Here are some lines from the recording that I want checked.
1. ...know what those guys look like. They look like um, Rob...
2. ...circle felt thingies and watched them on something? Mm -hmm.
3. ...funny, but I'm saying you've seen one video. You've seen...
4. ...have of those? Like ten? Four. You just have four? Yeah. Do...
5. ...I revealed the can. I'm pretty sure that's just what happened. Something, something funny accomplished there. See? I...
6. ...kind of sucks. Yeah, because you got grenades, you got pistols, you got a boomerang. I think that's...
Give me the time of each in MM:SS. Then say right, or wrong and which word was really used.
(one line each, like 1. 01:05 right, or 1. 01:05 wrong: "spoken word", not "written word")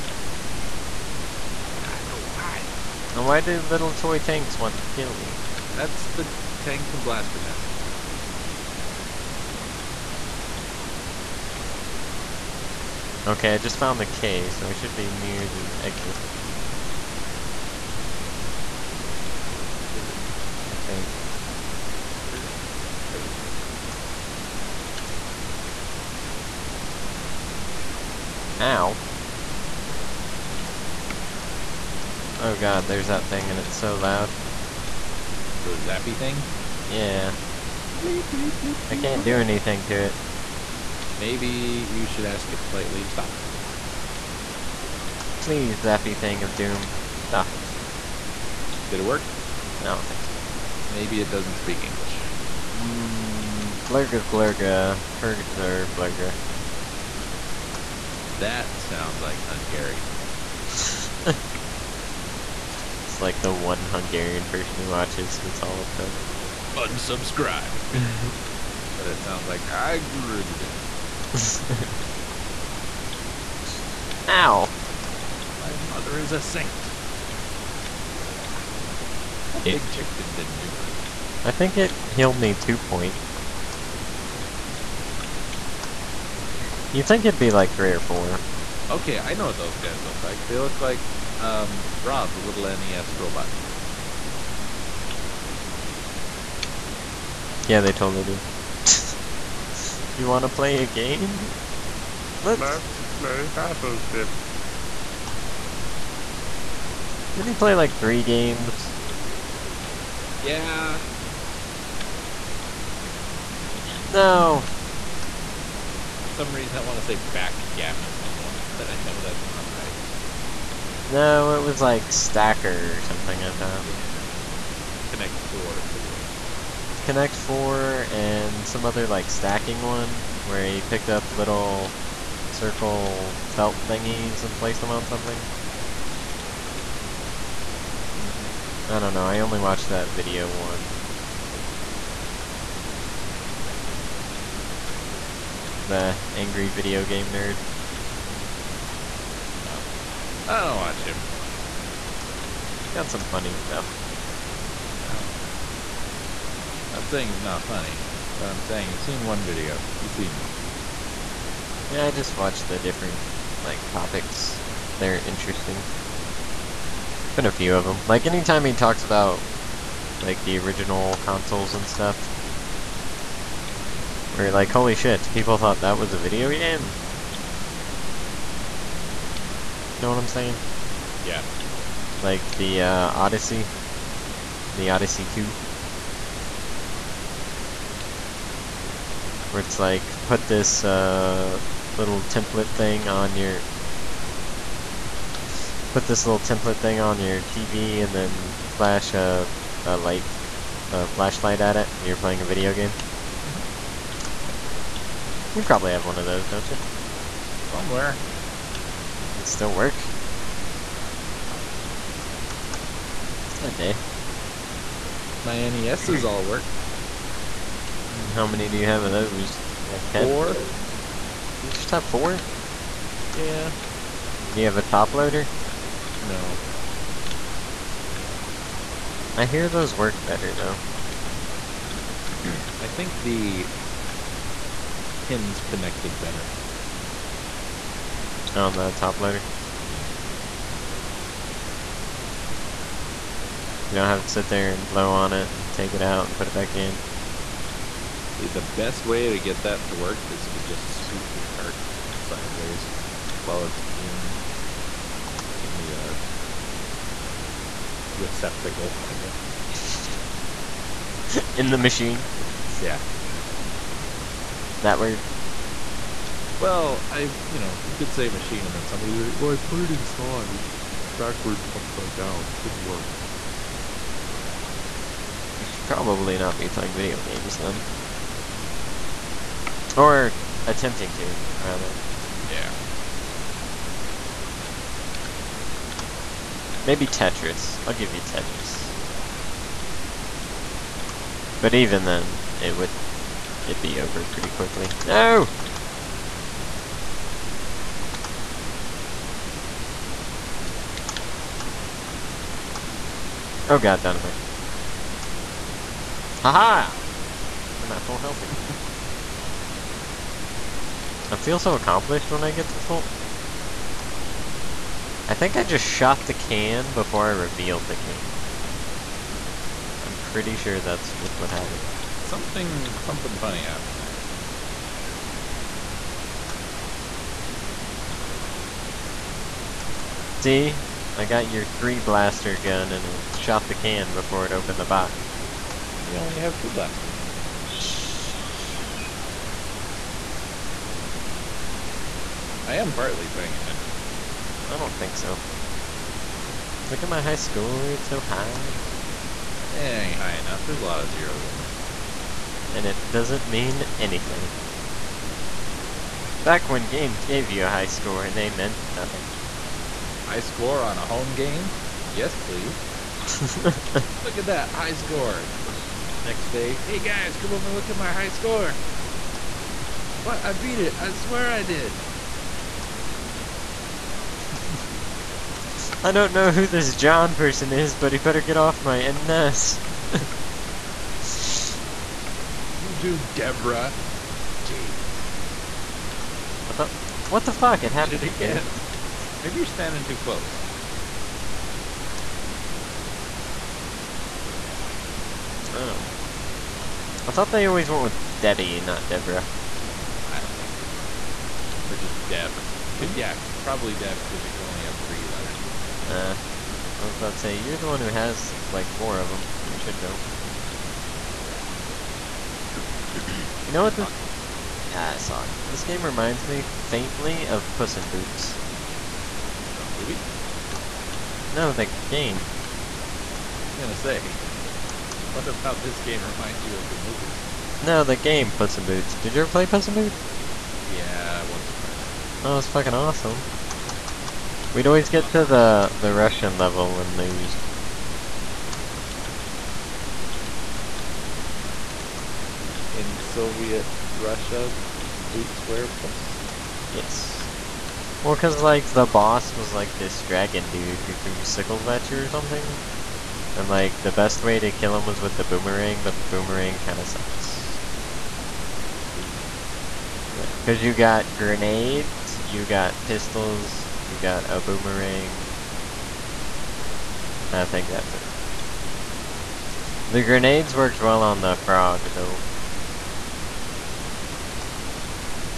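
1. 01:29 right
2. 02:12 wrong: "placed", not "watched"
3. 02:37 right
4. 03:38 right
5. 05:17 wrong: "happened", not "accomplished"
6. 07:36 right.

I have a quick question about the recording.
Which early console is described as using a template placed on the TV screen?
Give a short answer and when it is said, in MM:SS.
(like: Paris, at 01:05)
Odyssey 2, at 03:04.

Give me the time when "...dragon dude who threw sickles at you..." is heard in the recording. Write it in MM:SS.
07:30.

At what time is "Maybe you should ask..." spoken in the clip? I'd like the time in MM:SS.
00:41.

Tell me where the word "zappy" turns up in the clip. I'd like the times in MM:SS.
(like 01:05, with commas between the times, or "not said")
00:35, 00:45.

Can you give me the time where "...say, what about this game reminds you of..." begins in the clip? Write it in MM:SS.
07:03.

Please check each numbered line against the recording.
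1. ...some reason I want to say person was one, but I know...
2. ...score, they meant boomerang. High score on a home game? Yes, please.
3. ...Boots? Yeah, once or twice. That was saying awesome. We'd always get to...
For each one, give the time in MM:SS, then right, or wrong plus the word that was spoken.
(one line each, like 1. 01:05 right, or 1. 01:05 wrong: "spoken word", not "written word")
1. 01:56 wrong: "backgammon", not "person"
2. 05:57 wrong: "nothing", not "boomerang"
3. 07:09 wrong: "fucking", not "saying".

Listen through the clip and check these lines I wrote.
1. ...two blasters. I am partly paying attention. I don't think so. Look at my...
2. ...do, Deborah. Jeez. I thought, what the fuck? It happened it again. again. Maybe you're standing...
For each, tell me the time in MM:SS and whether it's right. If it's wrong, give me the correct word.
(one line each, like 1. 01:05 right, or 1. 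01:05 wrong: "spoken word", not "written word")
1. 05:36 right
2. 06:22 right.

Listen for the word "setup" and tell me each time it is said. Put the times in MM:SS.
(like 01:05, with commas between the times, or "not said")
not said.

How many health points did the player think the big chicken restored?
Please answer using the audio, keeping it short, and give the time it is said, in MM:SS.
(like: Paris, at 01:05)
2, at 01:22.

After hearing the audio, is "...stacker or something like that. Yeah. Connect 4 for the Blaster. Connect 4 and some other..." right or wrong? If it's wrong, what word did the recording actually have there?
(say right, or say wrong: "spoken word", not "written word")
wrong: "NES", not "Blaster".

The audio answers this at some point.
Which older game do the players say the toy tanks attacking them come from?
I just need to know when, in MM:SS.
00:07.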